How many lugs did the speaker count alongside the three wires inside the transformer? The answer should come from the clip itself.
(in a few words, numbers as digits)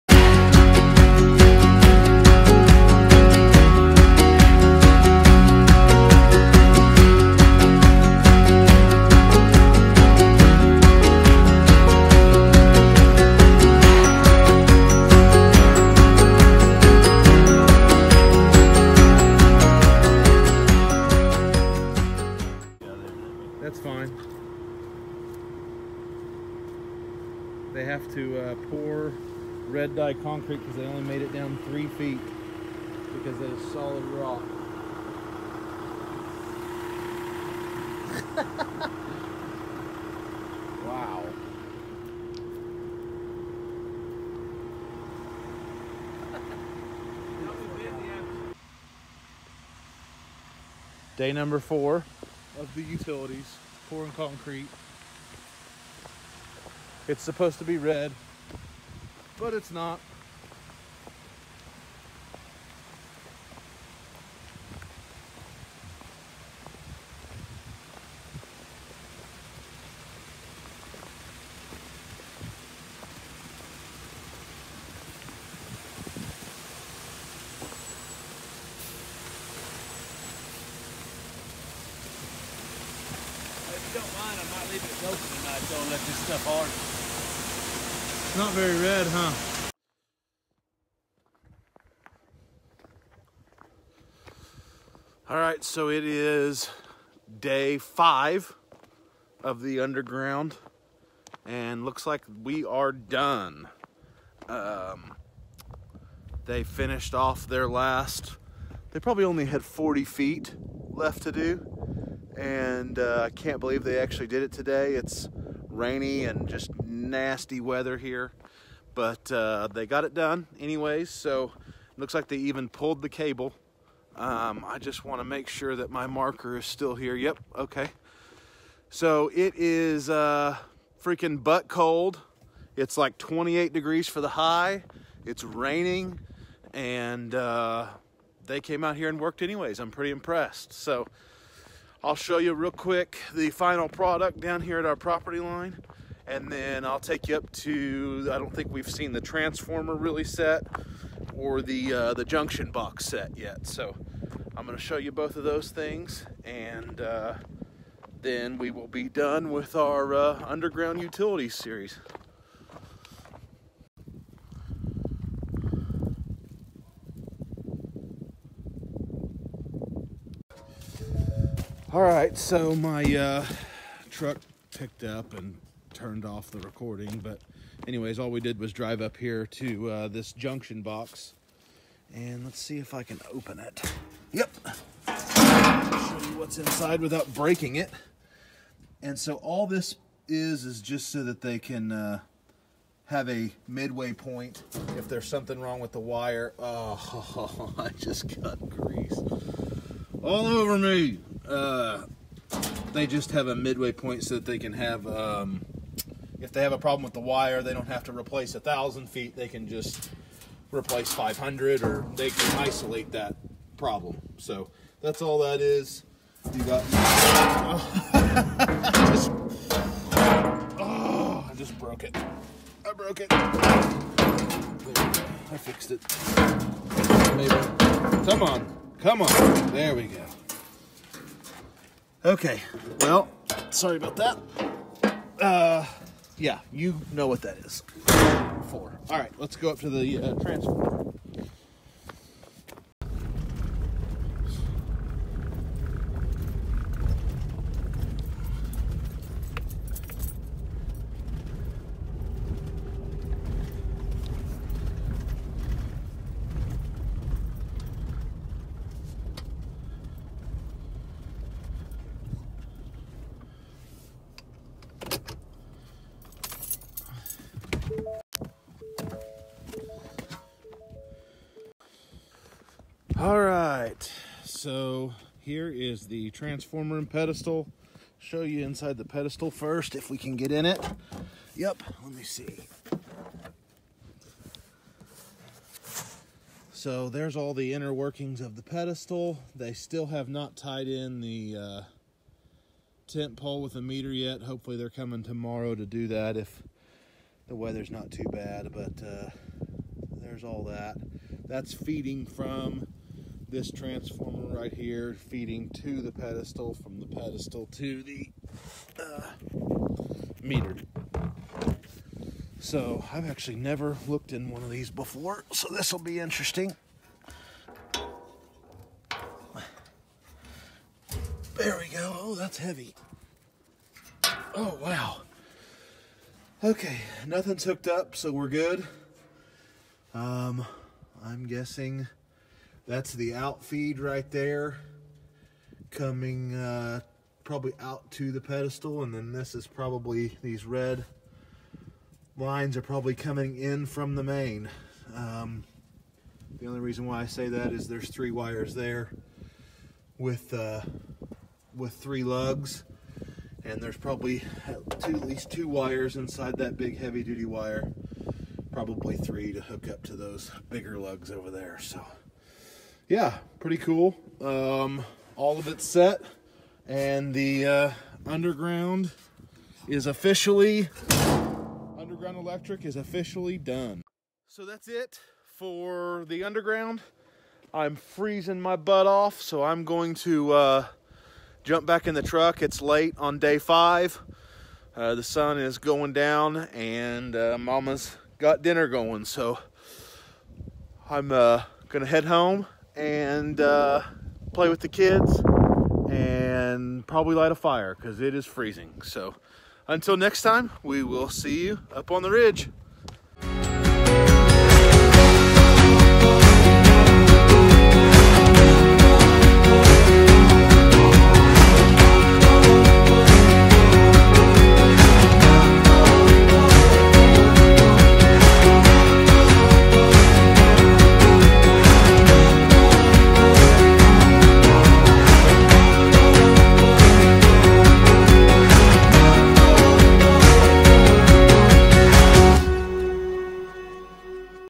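3.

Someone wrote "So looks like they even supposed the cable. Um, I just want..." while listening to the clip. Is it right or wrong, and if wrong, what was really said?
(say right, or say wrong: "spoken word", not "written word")
wrong: "pulled", not "supposed".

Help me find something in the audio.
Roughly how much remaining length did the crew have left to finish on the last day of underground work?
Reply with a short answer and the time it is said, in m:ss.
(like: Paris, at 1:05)
40 feet, at 1:49.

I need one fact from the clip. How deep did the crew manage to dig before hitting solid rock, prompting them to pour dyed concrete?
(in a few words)
3 feet.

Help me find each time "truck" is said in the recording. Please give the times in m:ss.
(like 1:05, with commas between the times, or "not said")
2:54, 6:22.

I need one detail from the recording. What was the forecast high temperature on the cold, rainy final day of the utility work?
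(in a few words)
28 degrees.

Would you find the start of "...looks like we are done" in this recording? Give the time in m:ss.
1:41.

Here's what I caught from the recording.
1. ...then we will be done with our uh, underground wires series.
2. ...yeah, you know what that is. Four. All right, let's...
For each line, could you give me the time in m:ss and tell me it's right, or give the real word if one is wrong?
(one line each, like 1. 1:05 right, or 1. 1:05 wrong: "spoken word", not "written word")
1. 2:38 wrong: "utilities", not "wires"
2. 3:56 right.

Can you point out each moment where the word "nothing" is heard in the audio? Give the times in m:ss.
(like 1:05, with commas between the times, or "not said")
5:27.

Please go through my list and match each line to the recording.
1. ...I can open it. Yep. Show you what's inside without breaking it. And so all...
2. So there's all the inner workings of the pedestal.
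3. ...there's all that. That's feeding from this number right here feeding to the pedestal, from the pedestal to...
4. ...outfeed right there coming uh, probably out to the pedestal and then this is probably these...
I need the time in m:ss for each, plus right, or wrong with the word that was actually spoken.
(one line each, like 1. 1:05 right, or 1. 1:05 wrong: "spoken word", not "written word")
1. 3:02 right
2. 4:46 right
3. 5:00 wrong: "transformer", not "number"
4. 5:33 right.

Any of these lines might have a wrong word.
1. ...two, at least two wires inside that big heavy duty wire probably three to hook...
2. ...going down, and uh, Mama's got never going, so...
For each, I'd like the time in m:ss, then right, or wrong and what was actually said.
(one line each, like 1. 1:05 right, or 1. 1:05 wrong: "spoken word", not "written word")
1. 5:55 right
2. 6:25 wrong: "dinner", not "never".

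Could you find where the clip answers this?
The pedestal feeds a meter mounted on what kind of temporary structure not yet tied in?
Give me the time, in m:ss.
4:53.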